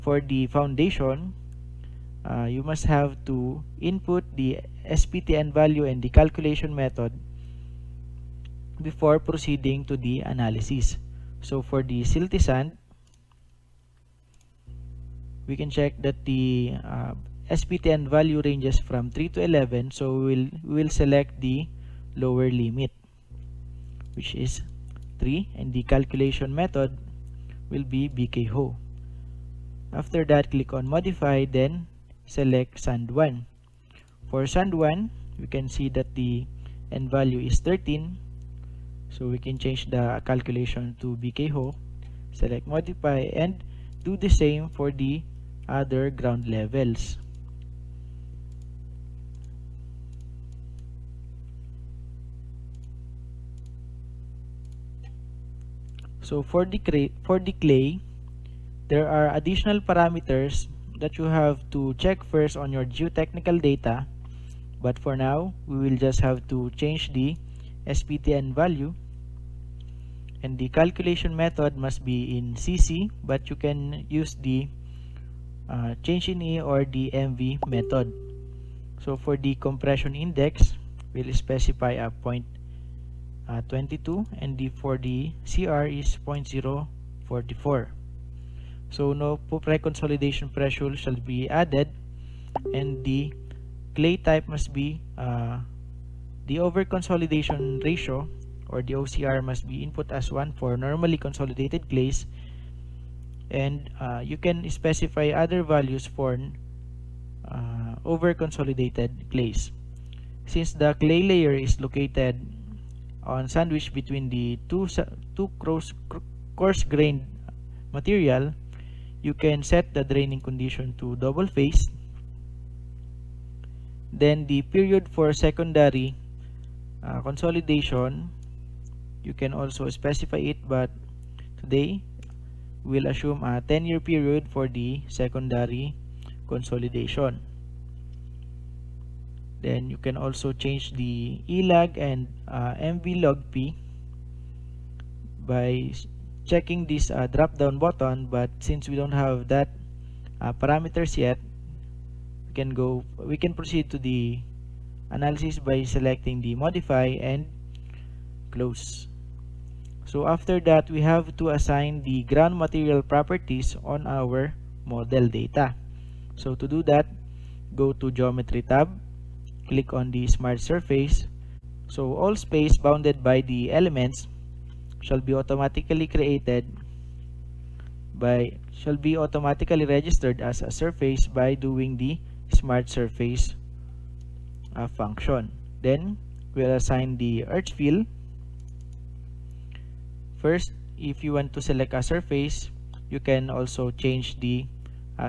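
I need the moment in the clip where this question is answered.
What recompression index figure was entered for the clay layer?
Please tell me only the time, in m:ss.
1:26.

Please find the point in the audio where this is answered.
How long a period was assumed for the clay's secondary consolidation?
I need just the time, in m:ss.
2:13.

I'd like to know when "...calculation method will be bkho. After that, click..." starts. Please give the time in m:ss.
0:25.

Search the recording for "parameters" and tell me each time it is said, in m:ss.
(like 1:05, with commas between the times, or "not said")
0:59, 2:30.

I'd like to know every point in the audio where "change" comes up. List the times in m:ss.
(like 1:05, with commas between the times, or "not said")
0:39, 1:06, 1:16, 2:20, 3:13.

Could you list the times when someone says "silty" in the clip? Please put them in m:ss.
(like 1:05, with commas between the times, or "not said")
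0:12.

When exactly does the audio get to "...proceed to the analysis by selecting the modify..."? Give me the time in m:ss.
2:33.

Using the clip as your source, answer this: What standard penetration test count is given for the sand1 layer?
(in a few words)
13.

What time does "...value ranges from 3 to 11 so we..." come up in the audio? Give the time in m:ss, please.
0:18.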